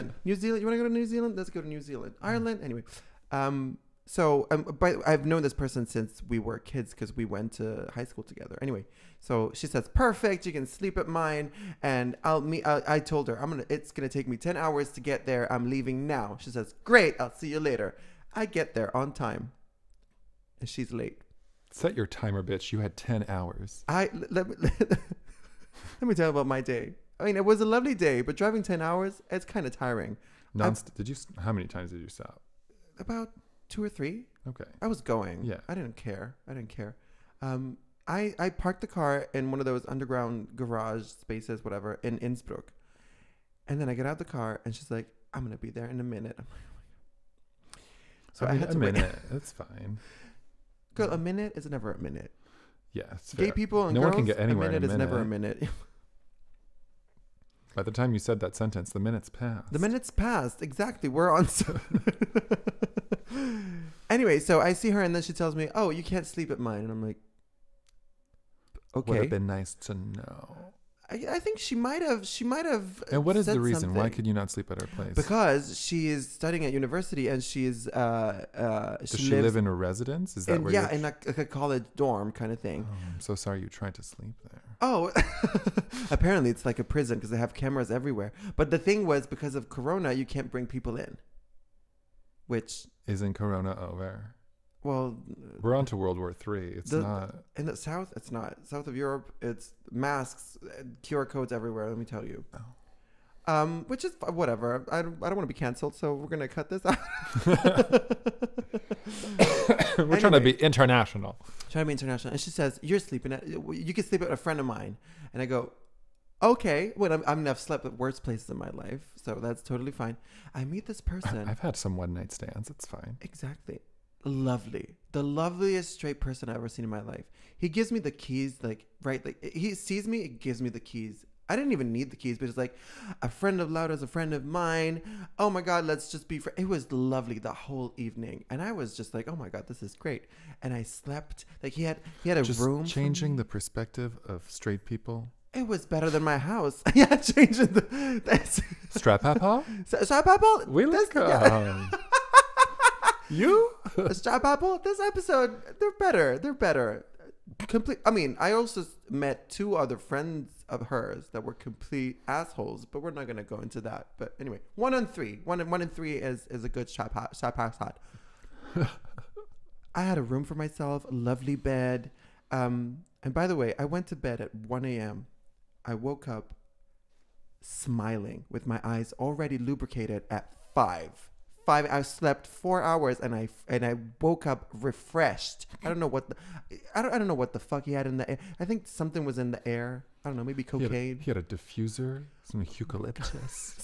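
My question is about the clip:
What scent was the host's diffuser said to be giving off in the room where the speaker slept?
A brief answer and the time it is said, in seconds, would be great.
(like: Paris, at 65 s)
Eucalyptus, at 192 s.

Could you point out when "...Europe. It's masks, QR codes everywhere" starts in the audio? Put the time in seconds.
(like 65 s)
98 s.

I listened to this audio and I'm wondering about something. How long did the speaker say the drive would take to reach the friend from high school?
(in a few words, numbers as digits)
10 hours.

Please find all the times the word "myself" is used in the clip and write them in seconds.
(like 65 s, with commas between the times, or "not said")
170 s.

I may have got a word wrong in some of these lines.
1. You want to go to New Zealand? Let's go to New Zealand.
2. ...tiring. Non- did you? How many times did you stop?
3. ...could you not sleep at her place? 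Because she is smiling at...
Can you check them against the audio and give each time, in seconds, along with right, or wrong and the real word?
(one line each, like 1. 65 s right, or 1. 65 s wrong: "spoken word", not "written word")
1. 0 s right
2. 29 s right
3. 74 s wrong: "studying", not "smiling".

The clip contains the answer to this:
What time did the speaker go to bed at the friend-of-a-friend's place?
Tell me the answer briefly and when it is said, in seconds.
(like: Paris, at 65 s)
1 a.m., at 174 s.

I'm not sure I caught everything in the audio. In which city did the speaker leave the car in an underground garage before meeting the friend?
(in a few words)
Innsbruck.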